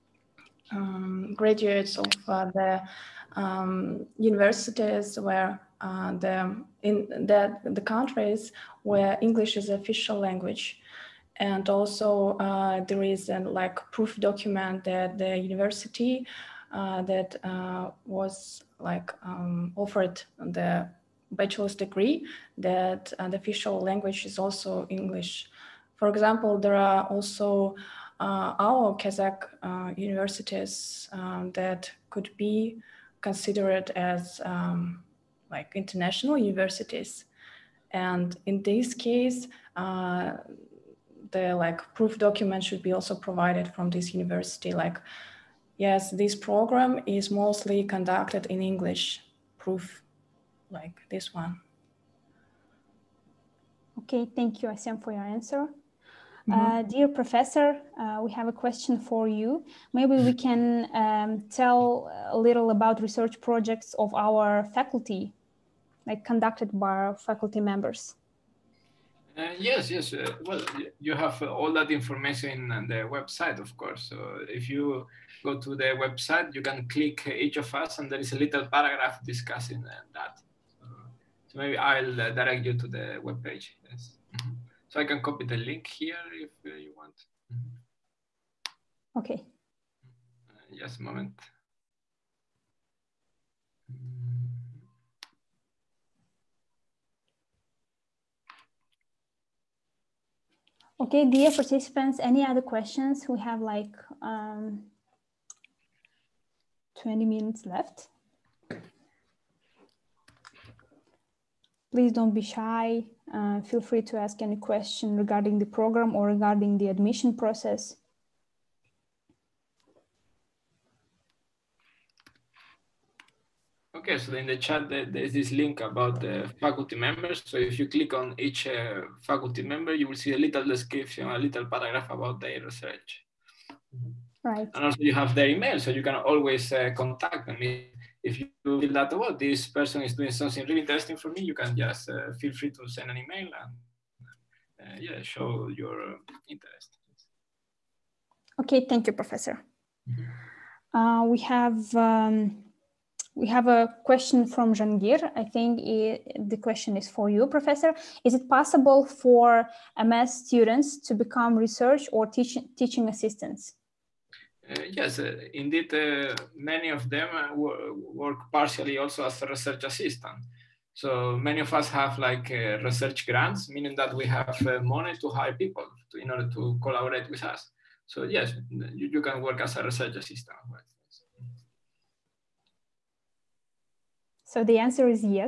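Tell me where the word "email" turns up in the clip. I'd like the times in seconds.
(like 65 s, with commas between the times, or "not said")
135 s, 143 s.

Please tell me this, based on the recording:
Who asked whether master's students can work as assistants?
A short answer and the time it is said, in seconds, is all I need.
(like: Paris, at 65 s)
Jangir, at 154 s.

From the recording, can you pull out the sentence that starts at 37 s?
And in this case, uh, the like proof document should be also provided from this university.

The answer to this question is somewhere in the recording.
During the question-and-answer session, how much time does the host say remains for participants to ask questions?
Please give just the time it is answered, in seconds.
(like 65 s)
107 s.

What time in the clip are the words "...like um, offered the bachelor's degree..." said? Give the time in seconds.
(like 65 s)
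18 s.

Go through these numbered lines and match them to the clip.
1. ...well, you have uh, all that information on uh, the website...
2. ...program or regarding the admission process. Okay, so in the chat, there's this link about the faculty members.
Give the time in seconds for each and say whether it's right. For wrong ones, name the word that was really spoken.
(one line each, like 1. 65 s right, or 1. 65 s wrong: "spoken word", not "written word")
1. 70 s right
2. 115 s right.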